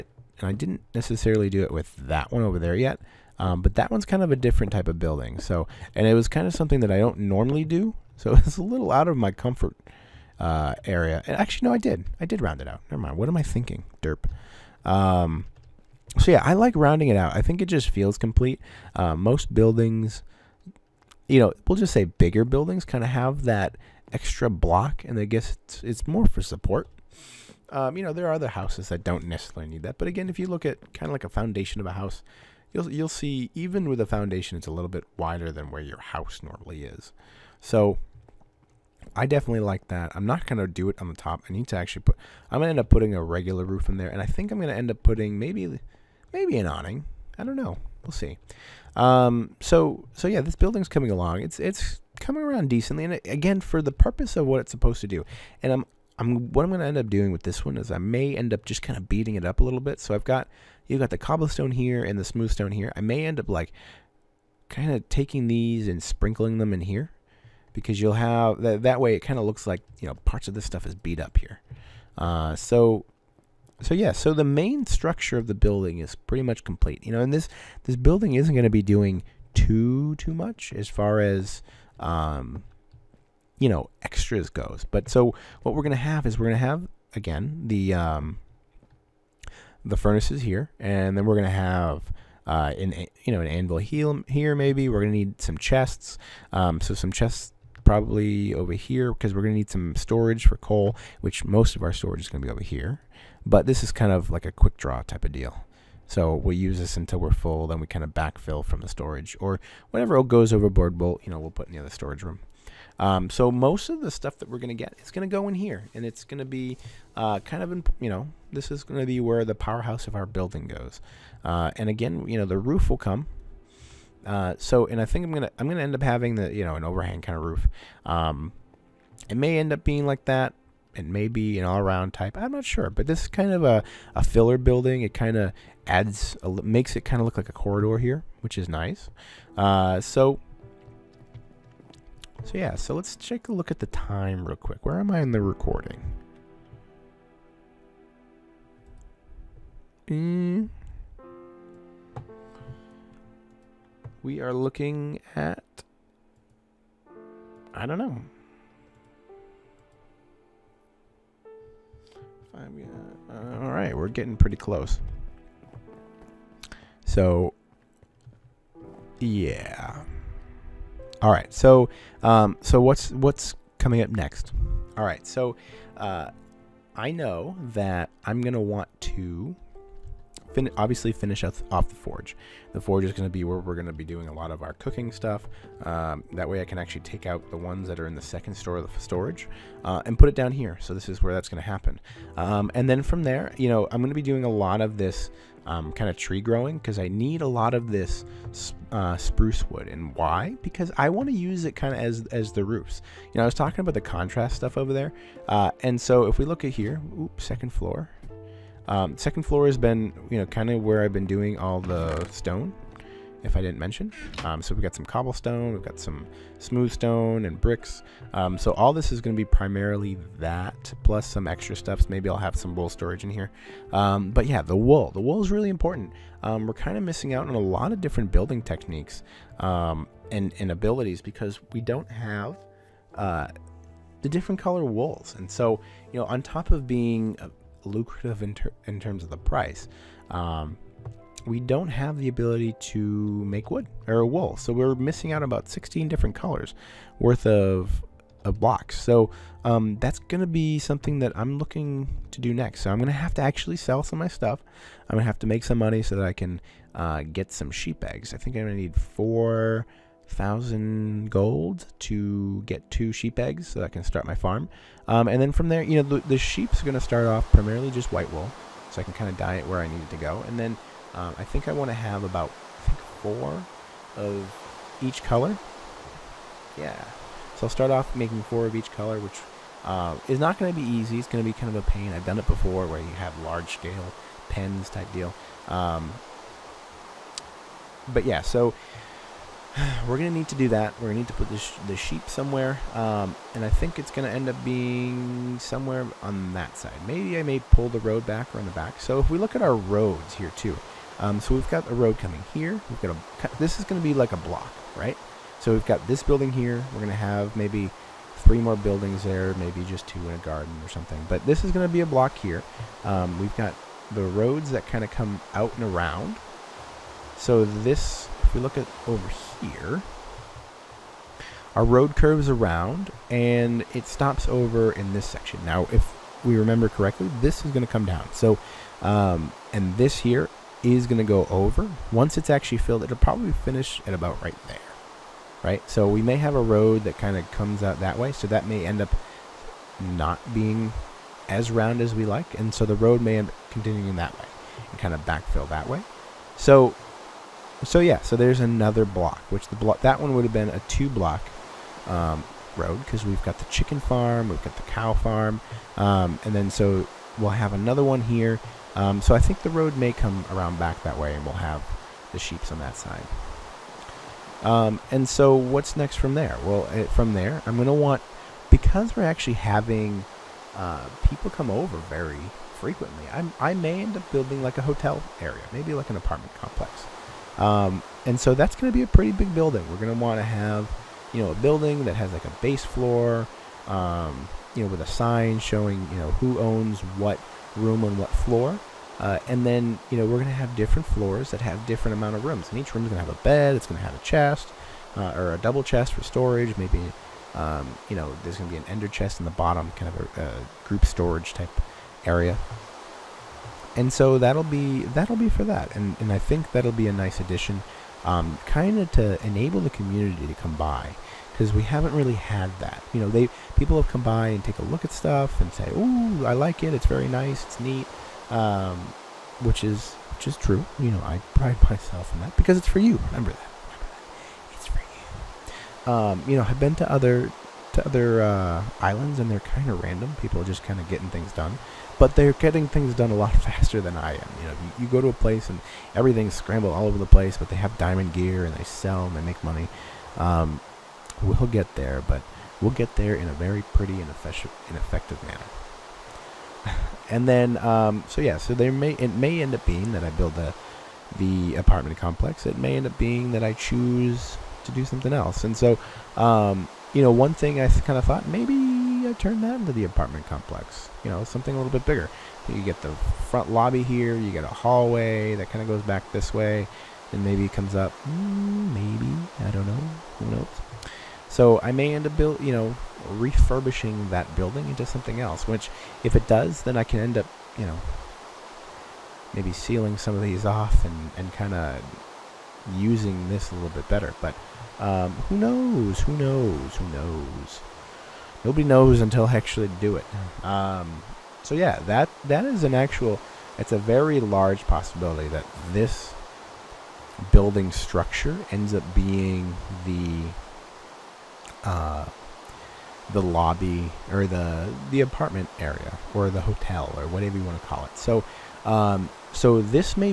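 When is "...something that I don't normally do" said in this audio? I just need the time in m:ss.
0:06.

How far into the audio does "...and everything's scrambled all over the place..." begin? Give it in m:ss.
7:15.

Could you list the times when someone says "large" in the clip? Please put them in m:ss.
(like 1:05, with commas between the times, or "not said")
4:43, 8:14.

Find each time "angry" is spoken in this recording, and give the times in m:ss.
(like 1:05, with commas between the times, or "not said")
not said.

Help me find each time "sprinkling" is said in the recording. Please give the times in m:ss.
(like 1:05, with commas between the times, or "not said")
1:06.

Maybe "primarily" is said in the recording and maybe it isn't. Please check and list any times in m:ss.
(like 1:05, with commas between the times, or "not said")
3:39, 4:27.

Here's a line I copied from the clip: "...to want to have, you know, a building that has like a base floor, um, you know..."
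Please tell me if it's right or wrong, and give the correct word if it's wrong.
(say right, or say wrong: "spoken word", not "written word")
right.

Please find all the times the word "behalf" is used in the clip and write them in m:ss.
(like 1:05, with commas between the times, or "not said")
not said.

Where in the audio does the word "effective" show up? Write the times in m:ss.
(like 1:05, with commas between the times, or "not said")
7:24.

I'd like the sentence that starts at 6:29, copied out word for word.
Uh, and then, you know, we're going to have different floors that have different amount of rooms.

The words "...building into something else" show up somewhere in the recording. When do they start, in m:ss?
7:54.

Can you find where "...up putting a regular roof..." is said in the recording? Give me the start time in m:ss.
0:42.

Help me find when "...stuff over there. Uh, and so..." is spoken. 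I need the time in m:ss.
3:24.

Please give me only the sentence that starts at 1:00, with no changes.
So I've got you've got the cobblestone here and the smooth stone here.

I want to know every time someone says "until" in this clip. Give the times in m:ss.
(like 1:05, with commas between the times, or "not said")
1:46, 8:09.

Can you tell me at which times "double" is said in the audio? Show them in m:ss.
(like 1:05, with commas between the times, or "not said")
6:35.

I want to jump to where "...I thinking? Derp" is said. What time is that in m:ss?
0:13.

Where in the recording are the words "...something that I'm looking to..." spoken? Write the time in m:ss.
4:10.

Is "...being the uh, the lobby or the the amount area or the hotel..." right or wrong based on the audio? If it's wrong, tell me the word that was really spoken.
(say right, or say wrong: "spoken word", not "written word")
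wrong: "apartment", not "amount".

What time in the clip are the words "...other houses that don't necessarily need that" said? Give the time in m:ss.
0:28.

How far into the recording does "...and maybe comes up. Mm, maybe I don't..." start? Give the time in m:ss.
7:47.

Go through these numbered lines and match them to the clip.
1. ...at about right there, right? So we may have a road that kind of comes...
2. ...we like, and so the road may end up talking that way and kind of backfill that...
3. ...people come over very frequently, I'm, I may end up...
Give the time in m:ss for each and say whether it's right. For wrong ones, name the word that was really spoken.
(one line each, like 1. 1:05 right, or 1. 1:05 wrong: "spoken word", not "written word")
1. 5:34 right
2. 5:42 wrong: "continuing", not "talking"
3. 6:11 right.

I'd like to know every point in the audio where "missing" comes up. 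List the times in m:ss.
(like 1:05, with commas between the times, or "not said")
3:47, 4:04.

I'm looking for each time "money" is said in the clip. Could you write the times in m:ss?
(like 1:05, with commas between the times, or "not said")
4:15, 7:19.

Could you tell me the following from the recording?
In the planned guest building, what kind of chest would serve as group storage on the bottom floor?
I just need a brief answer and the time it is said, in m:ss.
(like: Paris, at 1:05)
ender chest, at 6:38.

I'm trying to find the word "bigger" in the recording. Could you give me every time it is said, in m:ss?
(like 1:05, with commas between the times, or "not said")
0:22, 7:42.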